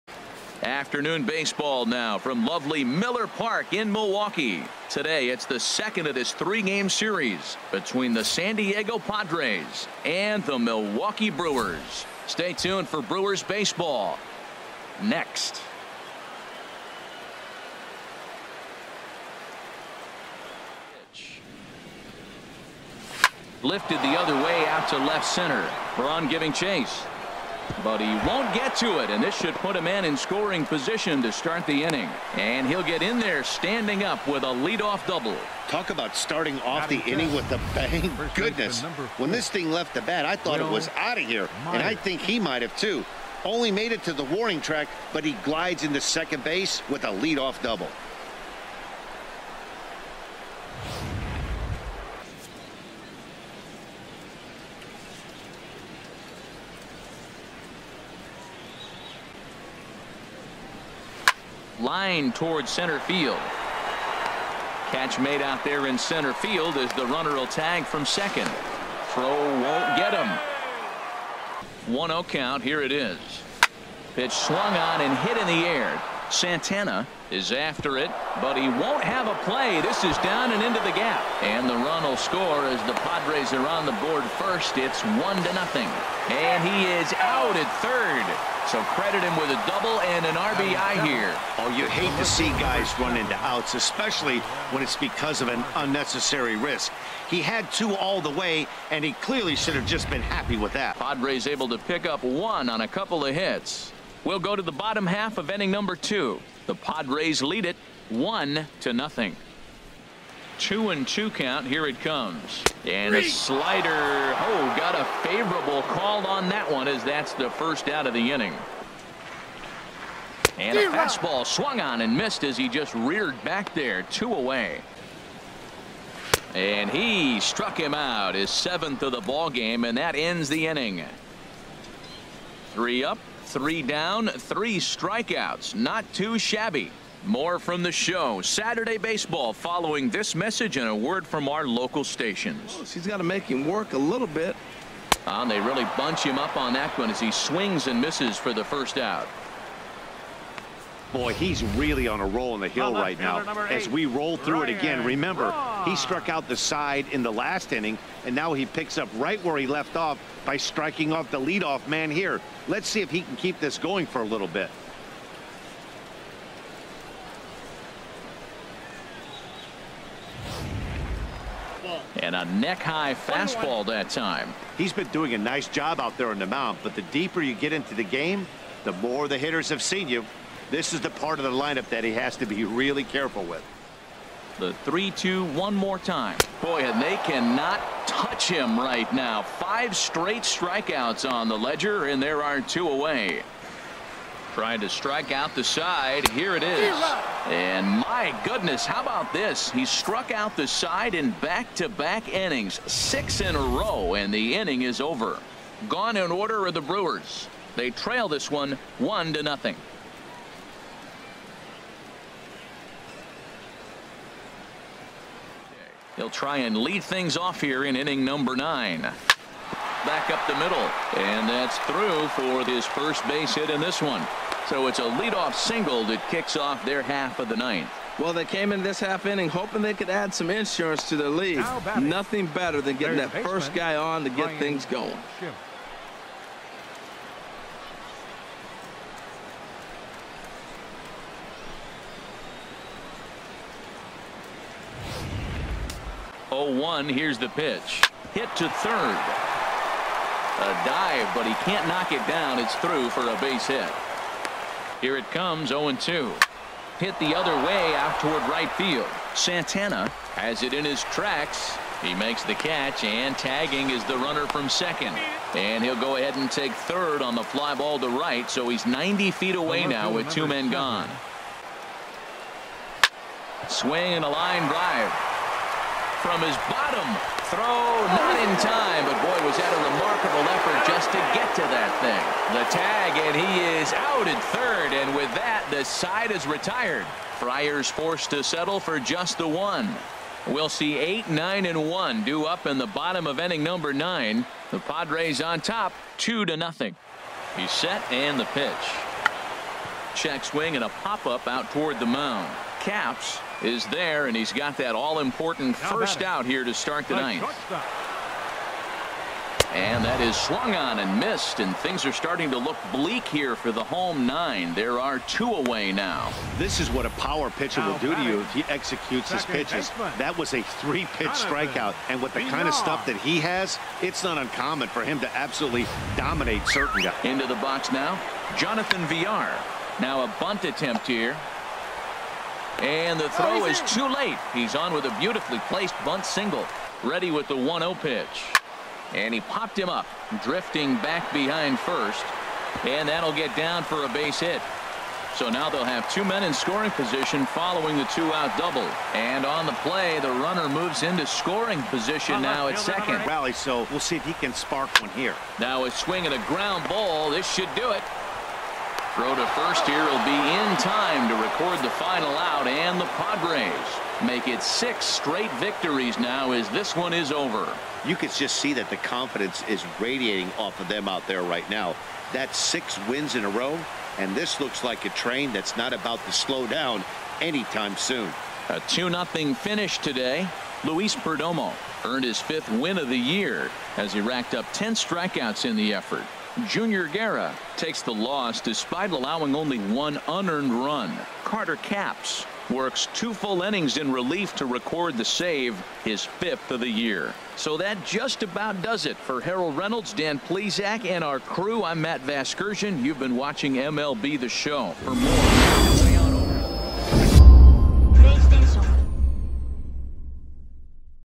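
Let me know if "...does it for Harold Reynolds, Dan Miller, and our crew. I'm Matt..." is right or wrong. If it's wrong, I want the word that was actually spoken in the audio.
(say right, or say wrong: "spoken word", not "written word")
wrong: "Plesac", not "Miller".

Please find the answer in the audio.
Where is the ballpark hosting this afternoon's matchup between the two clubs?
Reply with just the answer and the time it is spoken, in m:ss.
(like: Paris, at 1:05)
Miller Park, at 0:02.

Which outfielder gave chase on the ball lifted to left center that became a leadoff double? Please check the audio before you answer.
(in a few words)
Braun.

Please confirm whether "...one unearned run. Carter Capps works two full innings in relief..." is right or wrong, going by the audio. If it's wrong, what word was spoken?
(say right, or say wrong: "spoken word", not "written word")
right.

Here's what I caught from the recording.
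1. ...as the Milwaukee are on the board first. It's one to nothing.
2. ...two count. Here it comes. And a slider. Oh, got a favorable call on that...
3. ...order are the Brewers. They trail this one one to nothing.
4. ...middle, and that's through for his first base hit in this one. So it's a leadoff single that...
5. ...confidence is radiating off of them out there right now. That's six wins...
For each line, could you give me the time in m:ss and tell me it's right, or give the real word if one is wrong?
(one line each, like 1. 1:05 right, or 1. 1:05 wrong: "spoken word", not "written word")
1. 1:22 wrong: "Padres", not "Milwaukee"
2. 1:51 right
3. 3:26 right
4. 3:40 right
5. 6:08 right.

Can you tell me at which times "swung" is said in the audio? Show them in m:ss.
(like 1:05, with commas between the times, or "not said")
1:14, 2:01, 5:10.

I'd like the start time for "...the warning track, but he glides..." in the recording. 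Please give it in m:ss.
0:44.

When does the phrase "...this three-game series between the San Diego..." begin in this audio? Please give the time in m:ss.
0:06.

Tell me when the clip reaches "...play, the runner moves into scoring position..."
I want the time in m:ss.
5:49.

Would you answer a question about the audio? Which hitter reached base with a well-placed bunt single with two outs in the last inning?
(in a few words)
Jonathan Villar.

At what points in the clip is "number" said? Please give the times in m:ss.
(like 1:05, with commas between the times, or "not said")
1:45, 3:38, 4:53.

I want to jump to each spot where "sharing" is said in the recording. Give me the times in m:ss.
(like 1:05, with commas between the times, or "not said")
not said.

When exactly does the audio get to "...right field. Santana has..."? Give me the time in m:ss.
4:18.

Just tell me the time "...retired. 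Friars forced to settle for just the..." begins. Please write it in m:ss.
4:46.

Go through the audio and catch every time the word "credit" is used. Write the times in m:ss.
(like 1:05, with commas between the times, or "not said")
1:28.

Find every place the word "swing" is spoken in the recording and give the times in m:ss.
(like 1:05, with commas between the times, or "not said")
2:27, 4:33, 5:00, 5:55.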